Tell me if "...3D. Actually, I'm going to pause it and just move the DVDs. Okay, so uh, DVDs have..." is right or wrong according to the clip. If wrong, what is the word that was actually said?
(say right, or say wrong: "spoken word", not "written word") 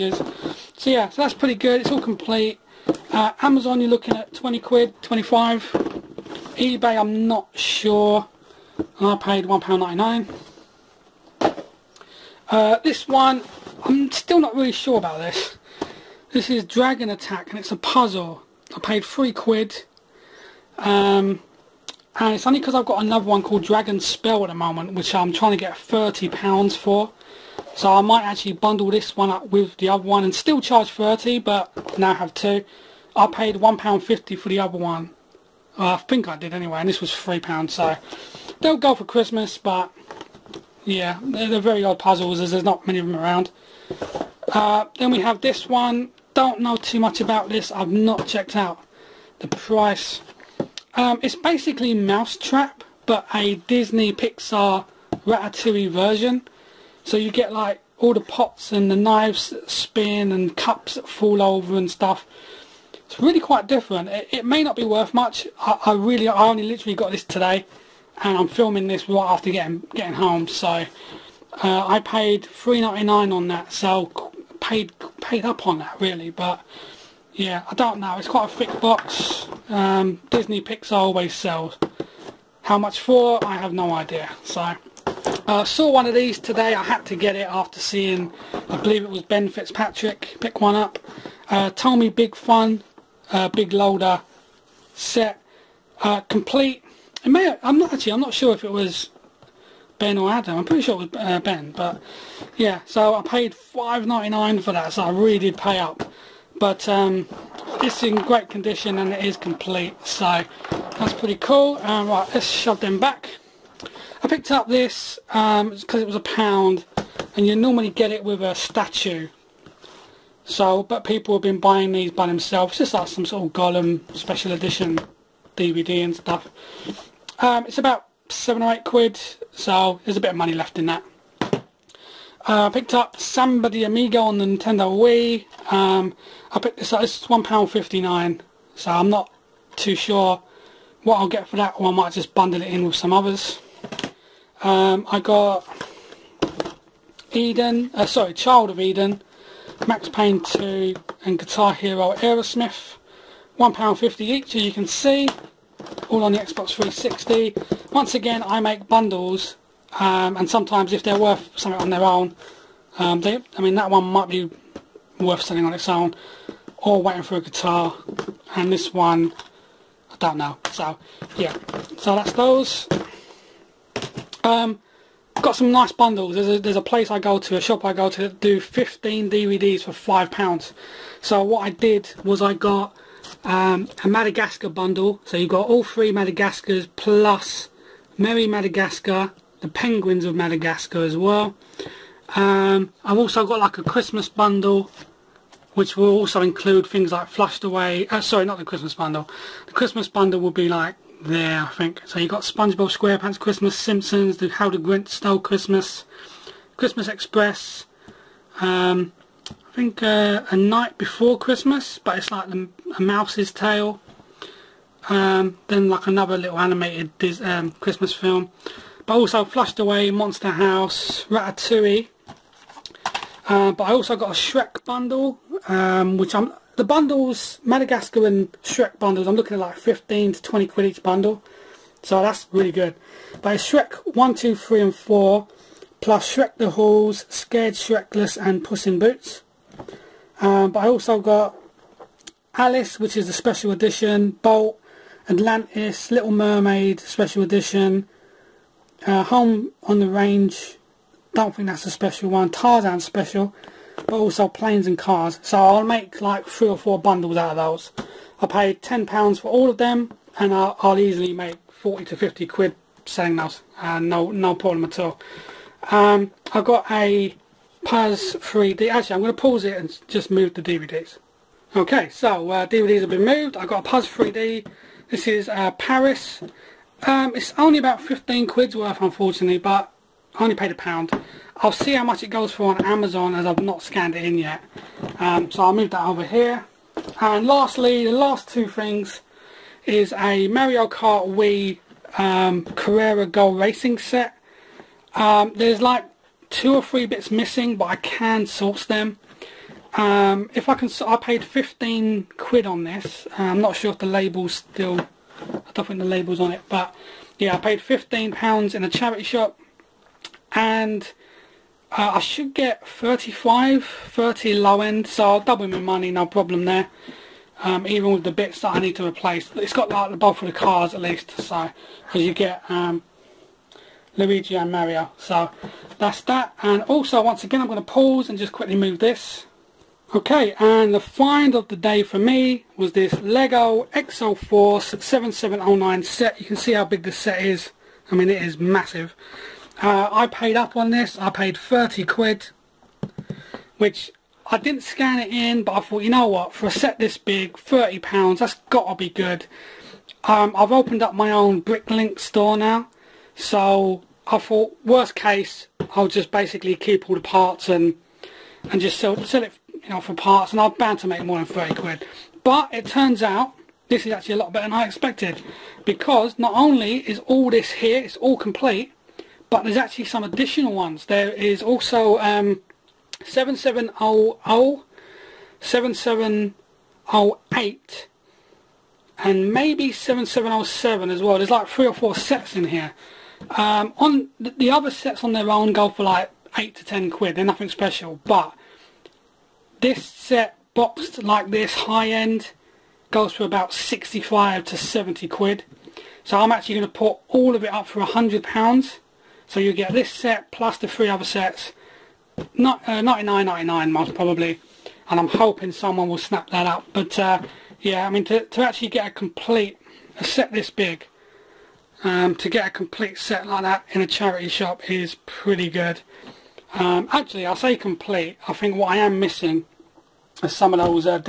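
right.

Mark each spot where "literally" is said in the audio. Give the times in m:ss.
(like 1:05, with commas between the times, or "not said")
1:06.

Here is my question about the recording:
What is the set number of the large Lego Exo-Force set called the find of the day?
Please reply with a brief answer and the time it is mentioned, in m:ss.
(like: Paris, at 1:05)
7709, at 5:34.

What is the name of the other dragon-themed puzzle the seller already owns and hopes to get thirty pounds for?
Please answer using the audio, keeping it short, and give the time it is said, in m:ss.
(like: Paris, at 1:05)
Dragon Spell, at 0:23.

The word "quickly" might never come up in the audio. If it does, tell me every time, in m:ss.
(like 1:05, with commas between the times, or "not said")
5:28.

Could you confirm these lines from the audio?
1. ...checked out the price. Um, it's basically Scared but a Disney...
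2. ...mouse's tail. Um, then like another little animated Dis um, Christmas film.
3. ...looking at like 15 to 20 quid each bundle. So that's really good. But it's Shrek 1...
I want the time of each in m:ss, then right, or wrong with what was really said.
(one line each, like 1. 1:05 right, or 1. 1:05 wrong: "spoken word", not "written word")
1. 0:48 wrong: "Mousetrap", not "Scared"
2. 3:33 right
3. 3:49 right.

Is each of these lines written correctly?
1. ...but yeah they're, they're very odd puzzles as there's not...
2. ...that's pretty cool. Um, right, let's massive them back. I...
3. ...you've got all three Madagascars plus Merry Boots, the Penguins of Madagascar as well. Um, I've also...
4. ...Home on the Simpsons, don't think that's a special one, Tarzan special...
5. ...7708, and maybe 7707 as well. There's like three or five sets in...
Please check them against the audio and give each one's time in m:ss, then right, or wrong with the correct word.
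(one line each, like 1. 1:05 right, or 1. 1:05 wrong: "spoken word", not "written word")
1. 0:39 right
2. 1:50 wrong: "shove", not "massive"
3. 3:05 wrong: "Madagascar", not "Boots"
4. 4:09 wrong: "Range", not "Simpsons"
5. 6:15 wrong: "four", not "five".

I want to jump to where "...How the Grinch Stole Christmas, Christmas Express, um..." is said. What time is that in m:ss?
3:24.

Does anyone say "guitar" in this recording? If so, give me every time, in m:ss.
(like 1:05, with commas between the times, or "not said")
2:31, 2:47.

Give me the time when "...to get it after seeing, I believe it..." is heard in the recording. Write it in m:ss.
1:27.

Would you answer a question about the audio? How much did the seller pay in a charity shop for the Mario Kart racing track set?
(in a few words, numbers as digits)
£15.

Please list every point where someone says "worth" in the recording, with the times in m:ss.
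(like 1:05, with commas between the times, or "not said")
1:04, 2:41, 2:45, 4:38.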